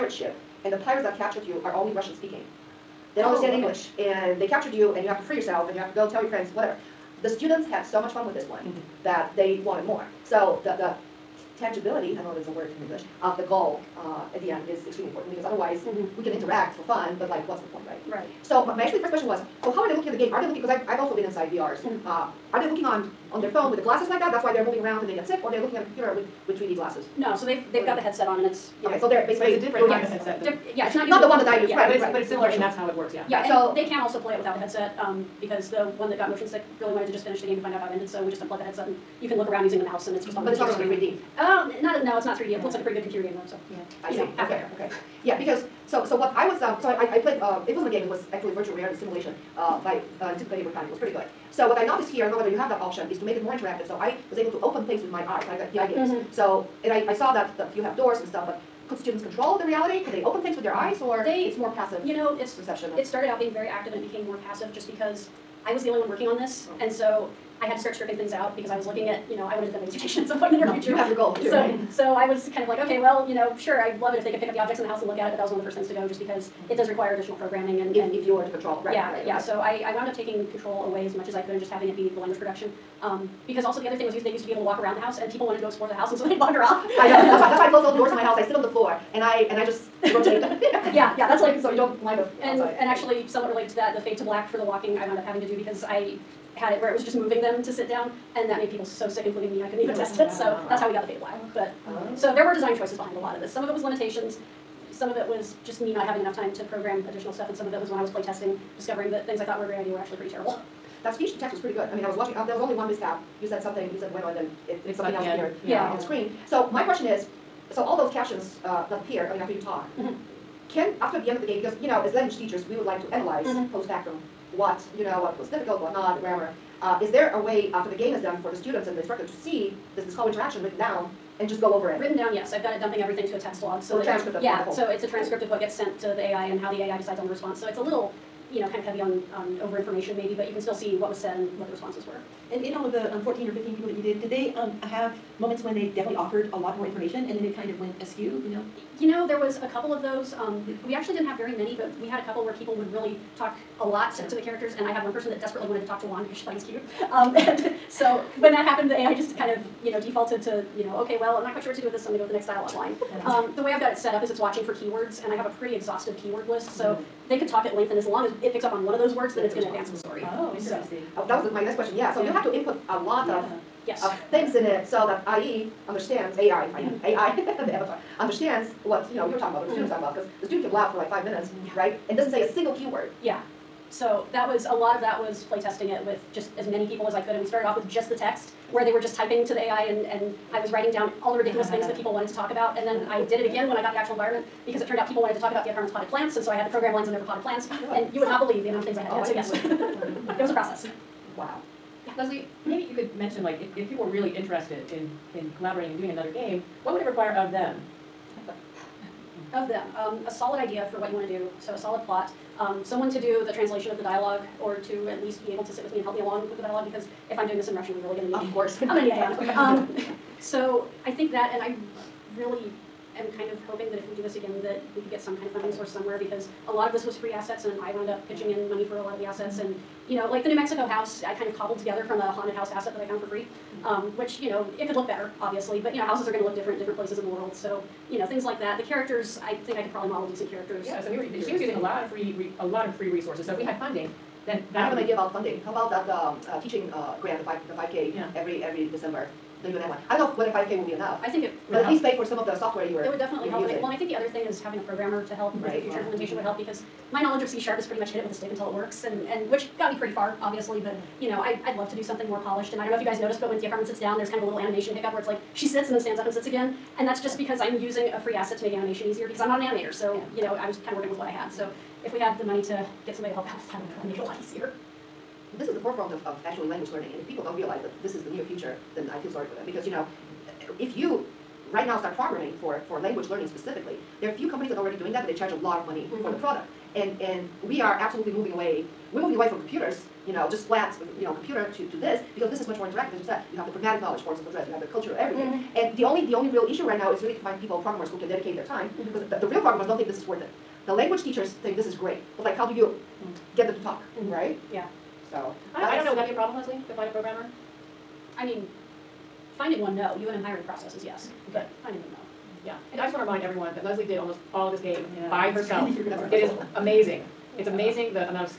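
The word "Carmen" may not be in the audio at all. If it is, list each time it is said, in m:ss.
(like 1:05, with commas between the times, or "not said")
3:15, 4:23.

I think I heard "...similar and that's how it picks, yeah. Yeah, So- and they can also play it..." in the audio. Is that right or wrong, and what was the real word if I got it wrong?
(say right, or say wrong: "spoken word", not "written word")
wrong: "works", not "picks".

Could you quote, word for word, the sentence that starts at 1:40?
So that's how we got the faded black.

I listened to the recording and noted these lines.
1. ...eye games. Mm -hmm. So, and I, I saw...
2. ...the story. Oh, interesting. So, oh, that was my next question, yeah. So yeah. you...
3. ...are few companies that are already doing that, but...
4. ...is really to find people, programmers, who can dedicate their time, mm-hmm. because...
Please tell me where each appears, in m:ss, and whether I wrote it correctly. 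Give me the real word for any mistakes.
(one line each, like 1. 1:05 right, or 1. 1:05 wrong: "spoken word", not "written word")
1. 0:55 right
2. 2:49 right
3. 4:44 right
4. 4:57 right.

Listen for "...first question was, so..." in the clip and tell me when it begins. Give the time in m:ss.
0:19.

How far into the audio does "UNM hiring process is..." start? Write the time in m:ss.
5:10.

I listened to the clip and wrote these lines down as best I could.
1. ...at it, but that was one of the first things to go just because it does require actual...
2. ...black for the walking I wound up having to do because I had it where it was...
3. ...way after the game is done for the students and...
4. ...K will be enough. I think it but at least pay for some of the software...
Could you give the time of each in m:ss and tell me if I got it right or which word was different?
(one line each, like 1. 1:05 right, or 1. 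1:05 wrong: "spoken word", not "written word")
1. 1:15 wrong: "additional", not "actual"
2. 1:34 right
3. 2:07 right
4. 4:10 right.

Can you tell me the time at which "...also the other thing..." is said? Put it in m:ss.
1:23.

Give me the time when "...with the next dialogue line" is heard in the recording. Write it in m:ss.
2:42.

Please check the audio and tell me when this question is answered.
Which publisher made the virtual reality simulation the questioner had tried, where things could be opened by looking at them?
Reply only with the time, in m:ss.
0:50.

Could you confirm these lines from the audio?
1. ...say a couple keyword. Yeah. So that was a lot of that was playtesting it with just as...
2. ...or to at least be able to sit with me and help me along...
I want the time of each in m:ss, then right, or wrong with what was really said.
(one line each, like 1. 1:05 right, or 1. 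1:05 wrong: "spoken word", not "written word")
1. 3:02 wrong: "single", not "couple"
2. 3:34 right.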